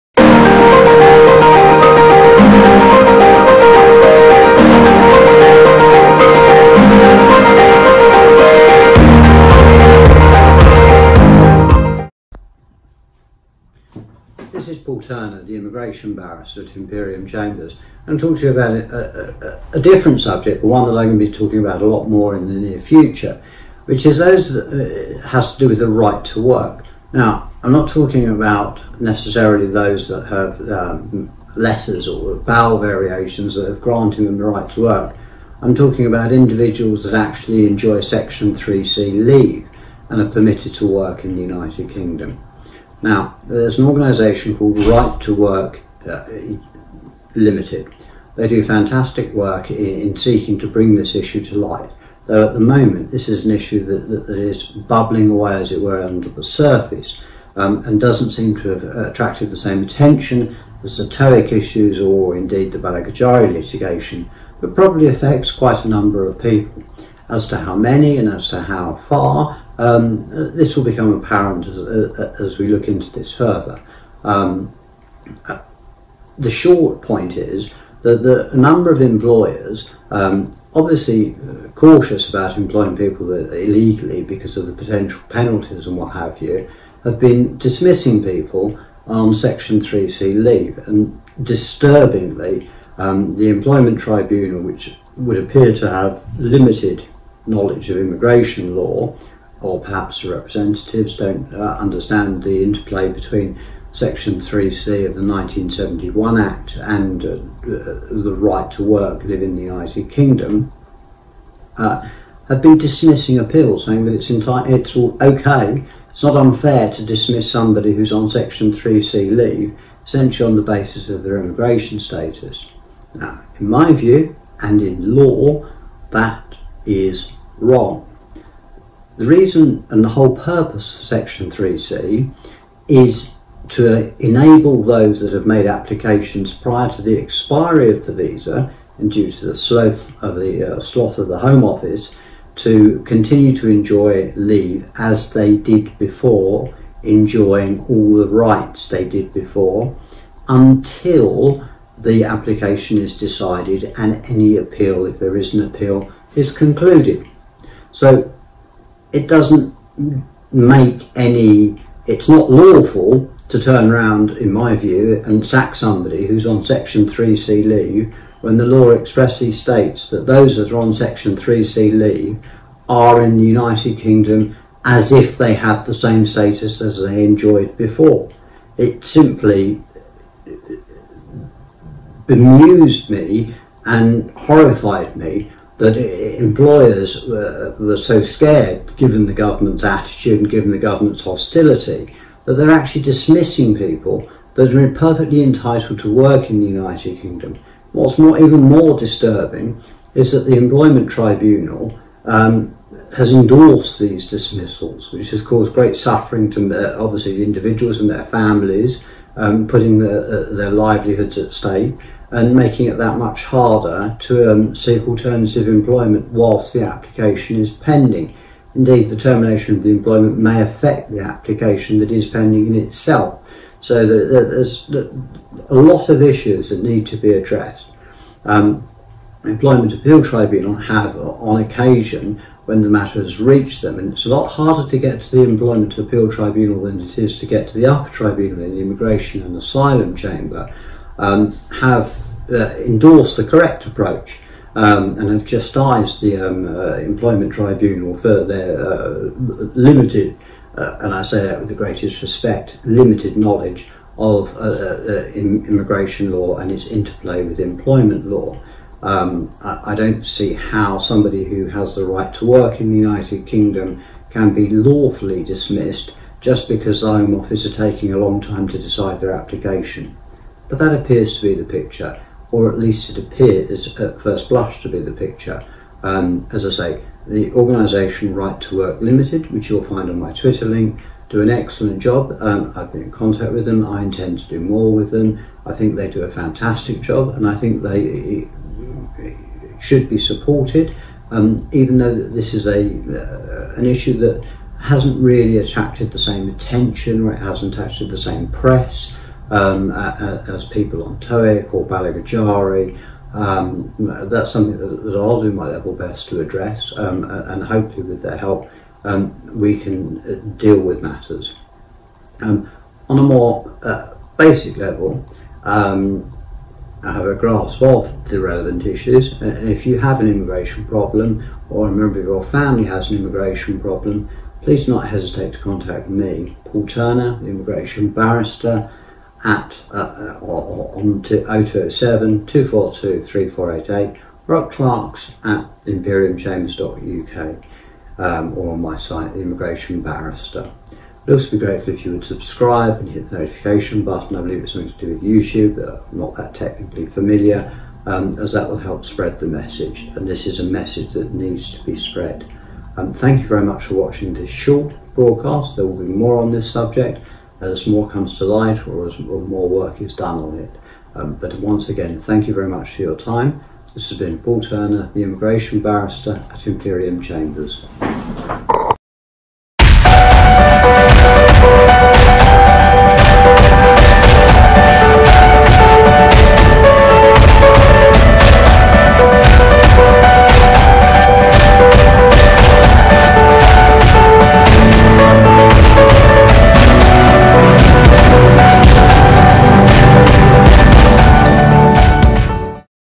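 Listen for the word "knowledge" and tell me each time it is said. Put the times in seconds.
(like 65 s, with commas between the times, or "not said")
97 s, 253 s.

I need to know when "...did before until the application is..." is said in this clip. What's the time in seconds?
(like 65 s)
149 s.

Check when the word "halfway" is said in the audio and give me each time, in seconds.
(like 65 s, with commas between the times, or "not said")
not said.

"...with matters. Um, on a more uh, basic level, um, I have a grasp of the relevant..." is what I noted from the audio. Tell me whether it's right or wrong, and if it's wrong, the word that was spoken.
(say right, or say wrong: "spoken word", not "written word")
right.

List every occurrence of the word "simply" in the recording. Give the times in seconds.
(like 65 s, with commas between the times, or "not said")
179 s.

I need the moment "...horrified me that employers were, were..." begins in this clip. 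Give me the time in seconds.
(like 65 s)
184 s.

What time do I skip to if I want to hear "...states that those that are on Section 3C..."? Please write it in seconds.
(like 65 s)
169 s.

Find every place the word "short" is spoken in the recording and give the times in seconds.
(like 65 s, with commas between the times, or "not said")
76 s, 354 s.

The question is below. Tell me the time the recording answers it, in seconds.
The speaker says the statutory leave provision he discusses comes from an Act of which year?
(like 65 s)
105 s.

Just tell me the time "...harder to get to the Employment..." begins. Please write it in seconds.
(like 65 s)
234 s.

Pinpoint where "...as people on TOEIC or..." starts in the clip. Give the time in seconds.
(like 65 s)
299 s.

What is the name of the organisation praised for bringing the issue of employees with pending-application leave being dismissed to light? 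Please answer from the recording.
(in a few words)
Right to Work Limited.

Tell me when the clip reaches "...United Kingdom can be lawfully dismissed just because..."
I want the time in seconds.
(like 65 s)
262 s.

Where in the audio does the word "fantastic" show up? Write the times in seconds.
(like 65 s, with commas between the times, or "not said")
48 s, 286 s.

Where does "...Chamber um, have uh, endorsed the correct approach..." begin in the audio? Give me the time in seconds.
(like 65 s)
240 s.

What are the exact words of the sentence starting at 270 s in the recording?
But that appears to be the picture, or at least it appears at first blush to be the picture.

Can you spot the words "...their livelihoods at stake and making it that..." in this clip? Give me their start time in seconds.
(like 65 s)
210 s.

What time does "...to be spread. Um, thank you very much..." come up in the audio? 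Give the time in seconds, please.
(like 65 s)
351 s.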